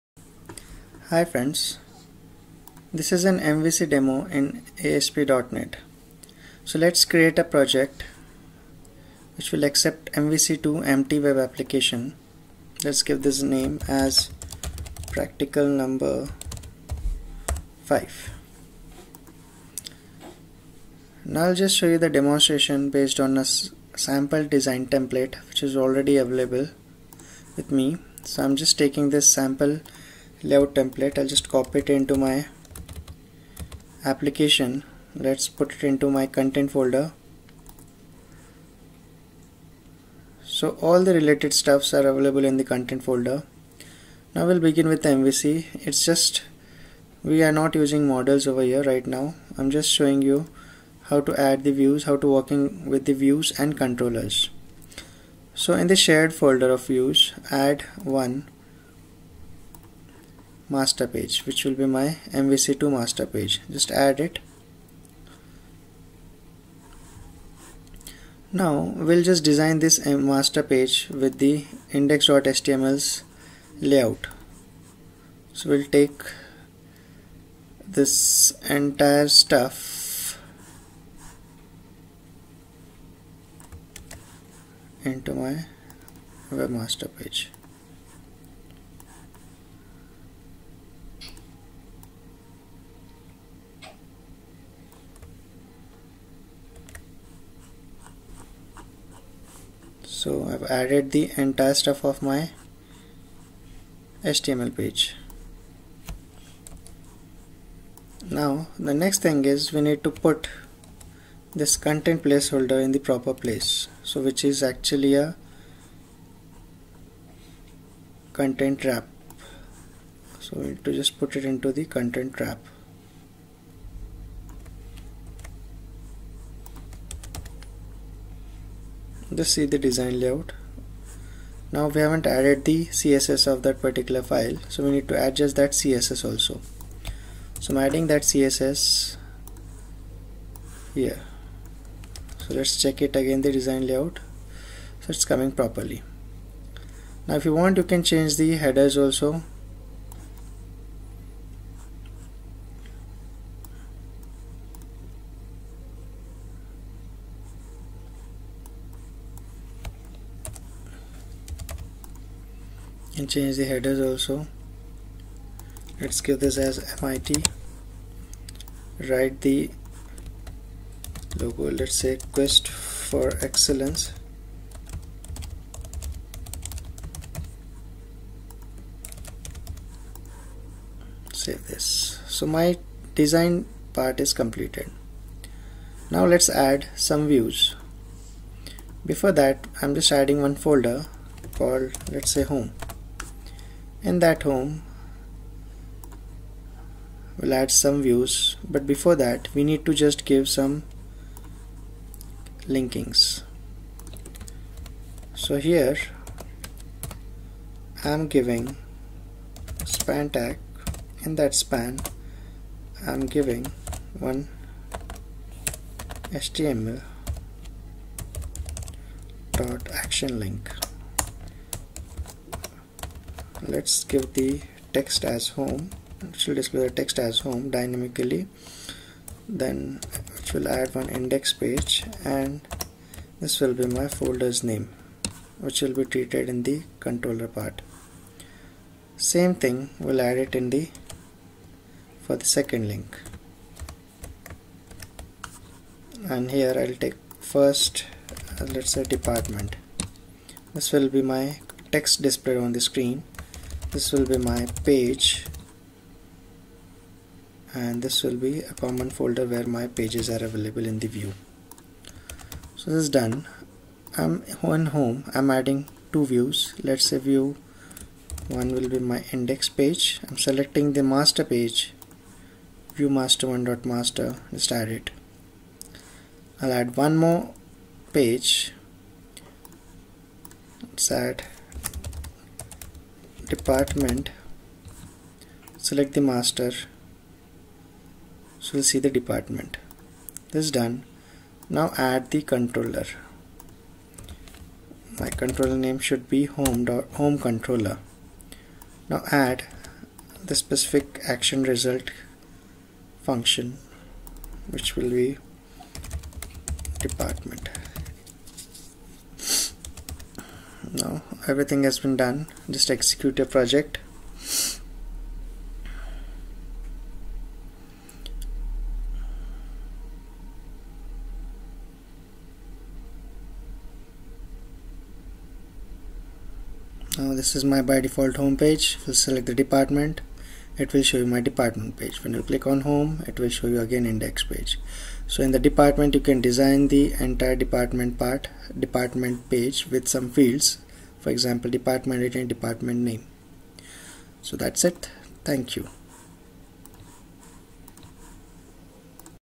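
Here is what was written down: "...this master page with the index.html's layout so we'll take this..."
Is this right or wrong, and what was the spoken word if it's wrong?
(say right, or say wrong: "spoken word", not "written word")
right.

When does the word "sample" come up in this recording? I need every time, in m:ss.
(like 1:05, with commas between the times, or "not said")
0:23, 0:29.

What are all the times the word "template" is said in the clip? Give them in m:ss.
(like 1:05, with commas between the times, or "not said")
0:24, 0:30.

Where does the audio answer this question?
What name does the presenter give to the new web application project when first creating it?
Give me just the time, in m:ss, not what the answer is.
0:15.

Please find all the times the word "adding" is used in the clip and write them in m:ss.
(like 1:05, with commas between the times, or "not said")
2:17, 3:10, 4:25.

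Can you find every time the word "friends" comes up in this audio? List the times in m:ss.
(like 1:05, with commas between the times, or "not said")
0:01.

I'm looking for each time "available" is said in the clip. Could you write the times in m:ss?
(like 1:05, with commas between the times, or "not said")
0:26, 0:42, 4:20.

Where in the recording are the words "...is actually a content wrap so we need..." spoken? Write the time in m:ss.
1:54.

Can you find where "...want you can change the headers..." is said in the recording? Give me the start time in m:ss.
2:27.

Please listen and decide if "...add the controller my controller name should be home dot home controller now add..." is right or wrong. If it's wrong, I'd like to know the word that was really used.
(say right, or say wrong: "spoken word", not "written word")
right.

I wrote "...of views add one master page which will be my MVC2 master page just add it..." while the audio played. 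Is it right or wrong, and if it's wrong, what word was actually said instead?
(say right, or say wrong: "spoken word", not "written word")
right.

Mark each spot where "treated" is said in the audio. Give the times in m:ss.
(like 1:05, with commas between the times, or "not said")
3:56.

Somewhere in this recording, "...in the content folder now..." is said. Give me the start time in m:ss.
0:42.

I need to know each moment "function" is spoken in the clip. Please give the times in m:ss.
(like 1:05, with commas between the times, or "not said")
5:03.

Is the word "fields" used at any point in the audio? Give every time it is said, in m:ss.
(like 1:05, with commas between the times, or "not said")
5:40.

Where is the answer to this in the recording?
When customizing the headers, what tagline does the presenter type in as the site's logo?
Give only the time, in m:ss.
2:52.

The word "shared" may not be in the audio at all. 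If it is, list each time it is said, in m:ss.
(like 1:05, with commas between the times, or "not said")
0:55.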